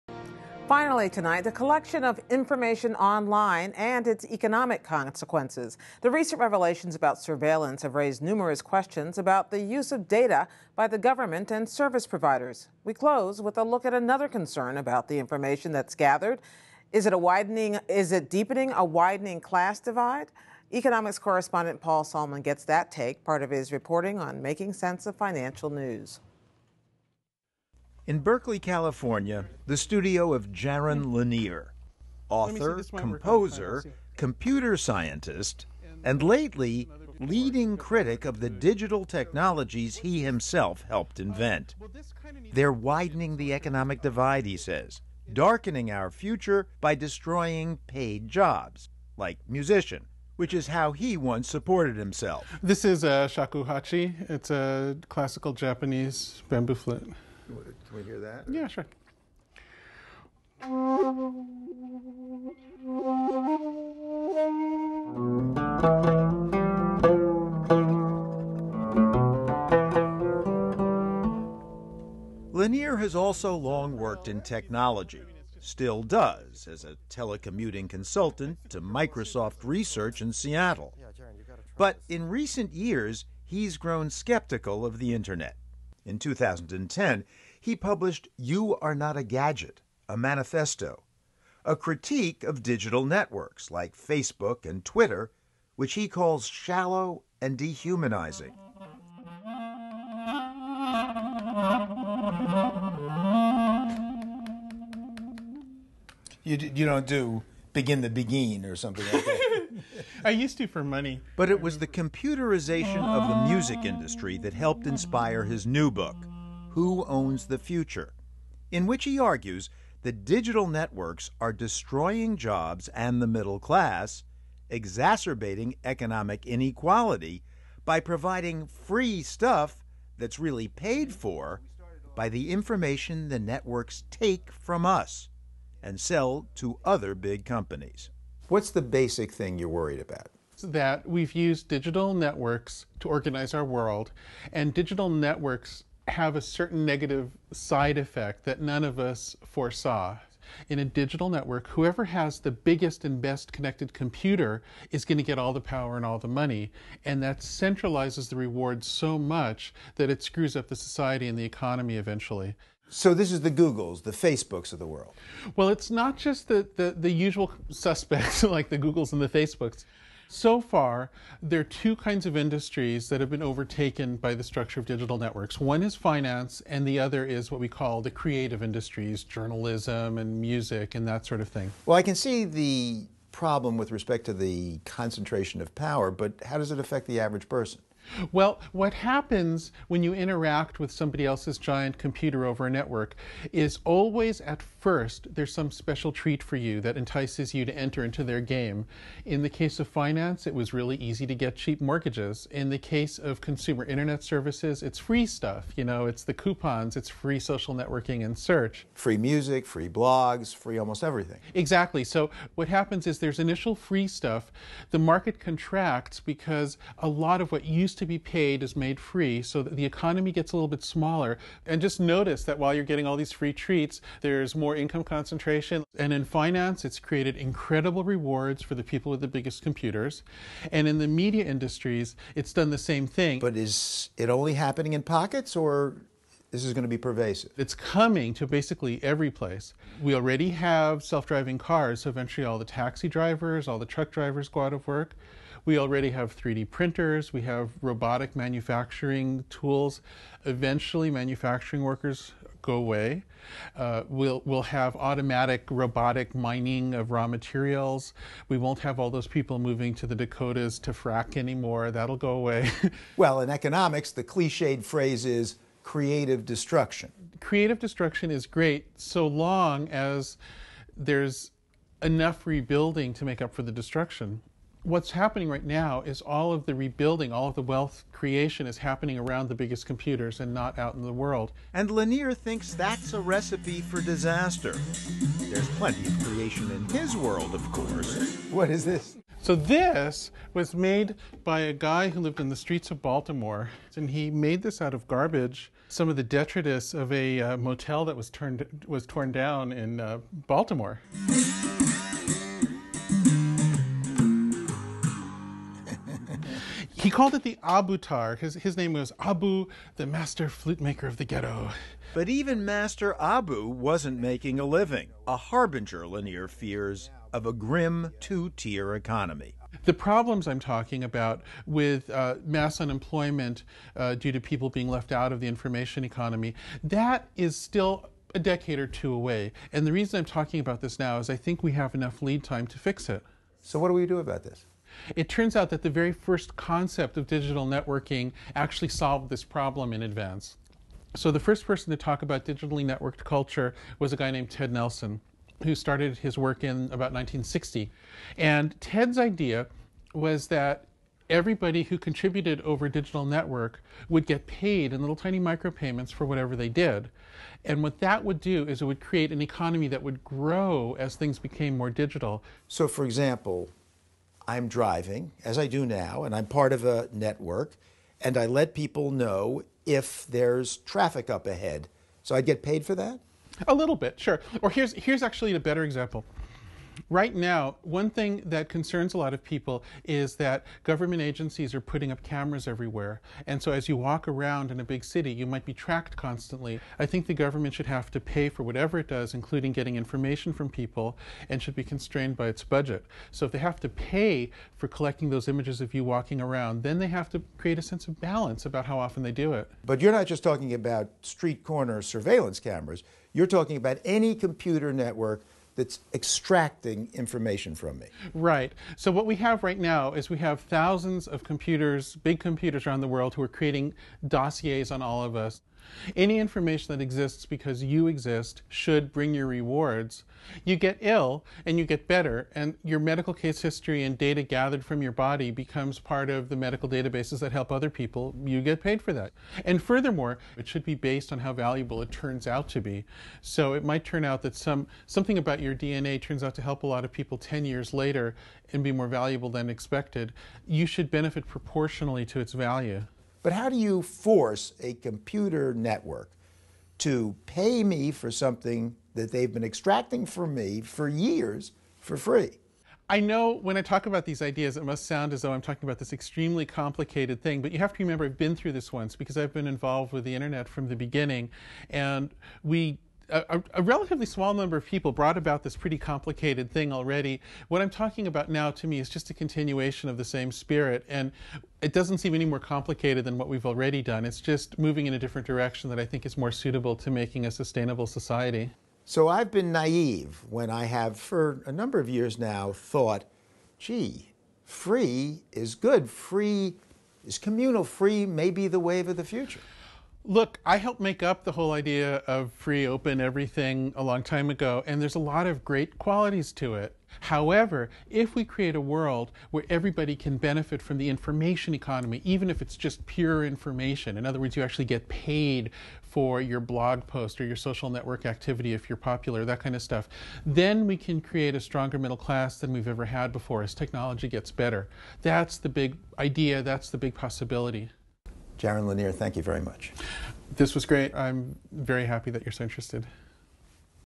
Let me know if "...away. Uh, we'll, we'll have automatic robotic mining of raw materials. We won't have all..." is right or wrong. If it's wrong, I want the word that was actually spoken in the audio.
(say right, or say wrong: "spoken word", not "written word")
right.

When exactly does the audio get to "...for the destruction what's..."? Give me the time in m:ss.
4:33.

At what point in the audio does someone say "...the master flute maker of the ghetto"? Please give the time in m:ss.
5:09.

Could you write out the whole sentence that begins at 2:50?
So far, there are two kinds of industries that have been overtaken by the structure of digital networks.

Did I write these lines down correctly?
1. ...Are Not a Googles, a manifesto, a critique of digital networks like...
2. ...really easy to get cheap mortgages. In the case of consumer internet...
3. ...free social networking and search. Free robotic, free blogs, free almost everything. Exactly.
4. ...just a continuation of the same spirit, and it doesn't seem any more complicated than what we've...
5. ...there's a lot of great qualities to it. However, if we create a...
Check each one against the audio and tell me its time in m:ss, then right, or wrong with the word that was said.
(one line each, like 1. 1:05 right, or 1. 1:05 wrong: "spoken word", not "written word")
1. 1:28 wrong: "Gadget", not "Googles"
2. 3:20 right
3. 3:27 wrong: "music", not "robotic"
4. 7:49 right
5. 8:15 right.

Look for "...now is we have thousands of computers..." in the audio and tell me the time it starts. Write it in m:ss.
6:49.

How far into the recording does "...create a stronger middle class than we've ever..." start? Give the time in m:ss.
8:31.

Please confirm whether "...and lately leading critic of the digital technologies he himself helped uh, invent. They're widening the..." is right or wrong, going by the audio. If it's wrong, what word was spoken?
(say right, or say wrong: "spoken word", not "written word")
right.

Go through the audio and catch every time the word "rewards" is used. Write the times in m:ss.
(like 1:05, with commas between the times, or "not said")
2:38, 3:48, 6:59.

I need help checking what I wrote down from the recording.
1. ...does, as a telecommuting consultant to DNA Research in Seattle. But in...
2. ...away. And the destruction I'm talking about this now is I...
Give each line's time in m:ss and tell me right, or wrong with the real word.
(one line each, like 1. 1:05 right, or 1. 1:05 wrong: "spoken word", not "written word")
1. 1:16 wrong: "Microsoft", not "DNA"
2. 5:29 wrong: "reason", not "destruction".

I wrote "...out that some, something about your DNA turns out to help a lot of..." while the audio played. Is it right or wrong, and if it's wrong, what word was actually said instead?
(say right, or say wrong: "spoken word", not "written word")
right.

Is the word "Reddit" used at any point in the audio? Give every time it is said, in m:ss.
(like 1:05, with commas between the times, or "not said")
not said.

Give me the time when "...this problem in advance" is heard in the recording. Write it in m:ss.
5:39.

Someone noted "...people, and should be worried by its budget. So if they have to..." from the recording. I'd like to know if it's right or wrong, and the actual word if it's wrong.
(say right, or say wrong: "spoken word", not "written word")
wrong: "constrained", not "worried".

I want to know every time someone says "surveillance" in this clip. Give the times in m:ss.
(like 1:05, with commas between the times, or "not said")
0:07, 6:42.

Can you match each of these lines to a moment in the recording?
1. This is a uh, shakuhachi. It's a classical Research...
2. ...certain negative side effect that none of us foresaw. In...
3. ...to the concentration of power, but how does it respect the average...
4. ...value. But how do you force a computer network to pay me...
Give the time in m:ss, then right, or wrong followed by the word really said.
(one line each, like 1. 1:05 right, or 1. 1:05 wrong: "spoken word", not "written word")
1. 0:52 wrong: "Japanese", not "Research"
2. 2:26 right
3. 3:04 wrong: "affect", not "respect"
4. 7:22 right.